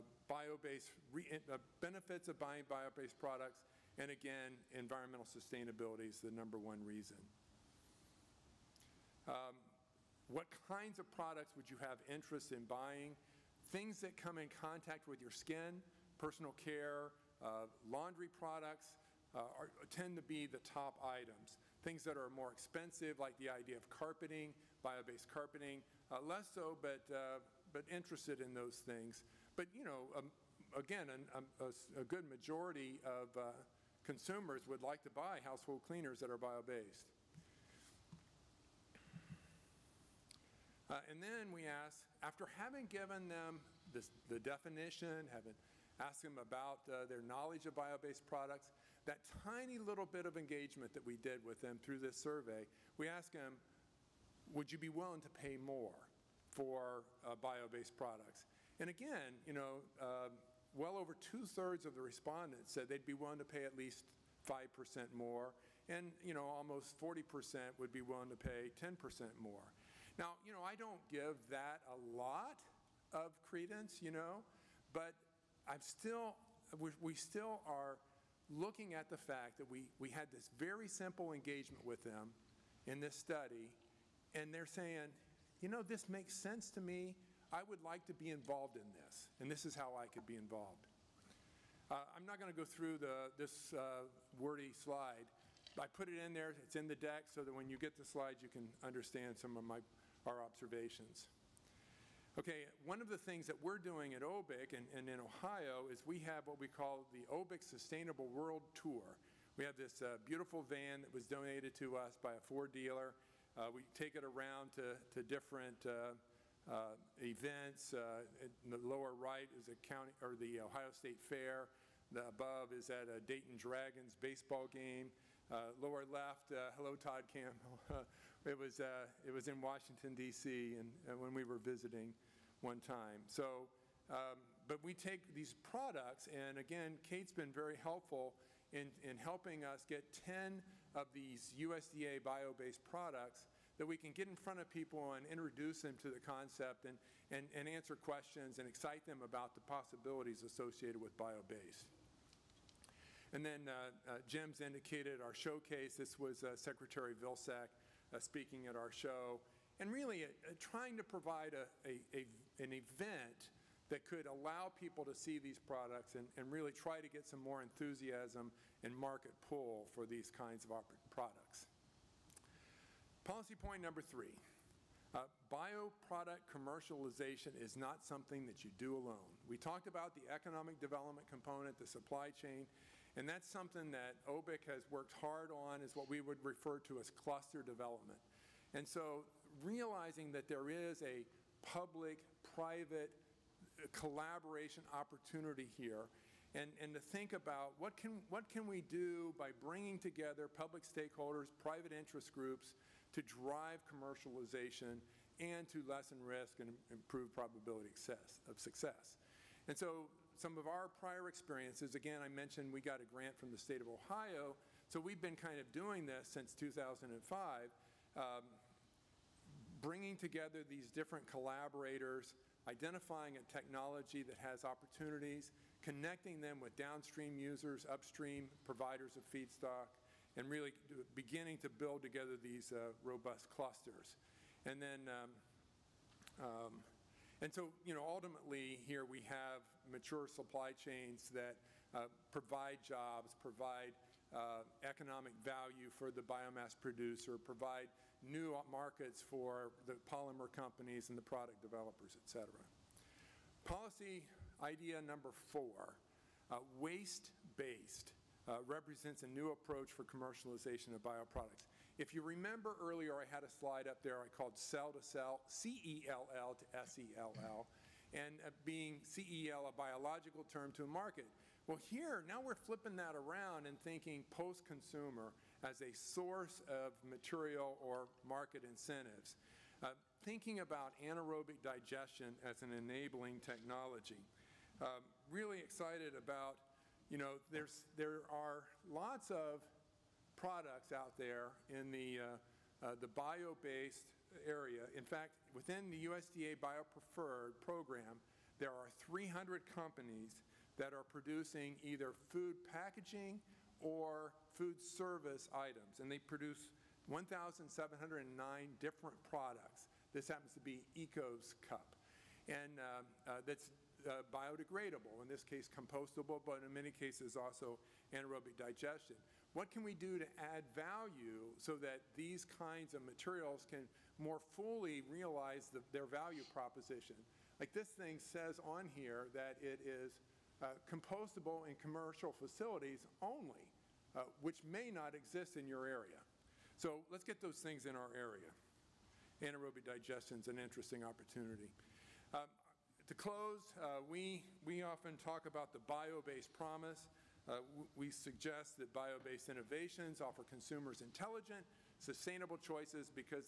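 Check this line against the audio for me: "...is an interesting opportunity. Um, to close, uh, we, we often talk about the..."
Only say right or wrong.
right.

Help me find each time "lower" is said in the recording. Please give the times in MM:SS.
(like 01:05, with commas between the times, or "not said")
01:58, 02:05.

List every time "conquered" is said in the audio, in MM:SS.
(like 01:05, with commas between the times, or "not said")
not said.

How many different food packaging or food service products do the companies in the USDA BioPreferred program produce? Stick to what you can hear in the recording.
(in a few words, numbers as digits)
1,709.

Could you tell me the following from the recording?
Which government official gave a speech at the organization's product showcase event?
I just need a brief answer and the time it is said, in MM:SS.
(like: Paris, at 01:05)
Secretary Vilsack, at 02:36.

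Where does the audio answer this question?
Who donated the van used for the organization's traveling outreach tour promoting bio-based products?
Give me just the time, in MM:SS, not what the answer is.
01:52.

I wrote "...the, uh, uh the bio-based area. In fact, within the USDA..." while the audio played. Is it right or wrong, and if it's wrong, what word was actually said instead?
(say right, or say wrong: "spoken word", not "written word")
right.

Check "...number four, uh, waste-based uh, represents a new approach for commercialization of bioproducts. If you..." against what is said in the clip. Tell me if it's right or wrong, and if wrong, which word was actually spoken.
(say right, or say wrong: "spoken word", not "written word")
right.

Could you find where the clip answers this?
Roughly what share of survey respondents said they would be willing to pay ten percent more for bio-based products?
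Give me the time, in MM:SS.
01:06.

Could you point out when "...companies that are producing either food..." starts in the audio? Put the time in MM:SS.
04:59.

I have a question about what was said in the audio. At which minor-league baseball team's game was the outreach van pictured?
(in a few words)
Dayton Dragons.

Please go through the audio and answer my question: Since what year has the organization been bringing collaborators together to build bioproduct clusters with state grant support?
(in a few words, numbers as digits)
2005.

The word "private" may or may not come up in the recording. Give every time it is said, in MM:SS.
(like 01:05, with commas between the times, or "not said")
03:11, 03:21.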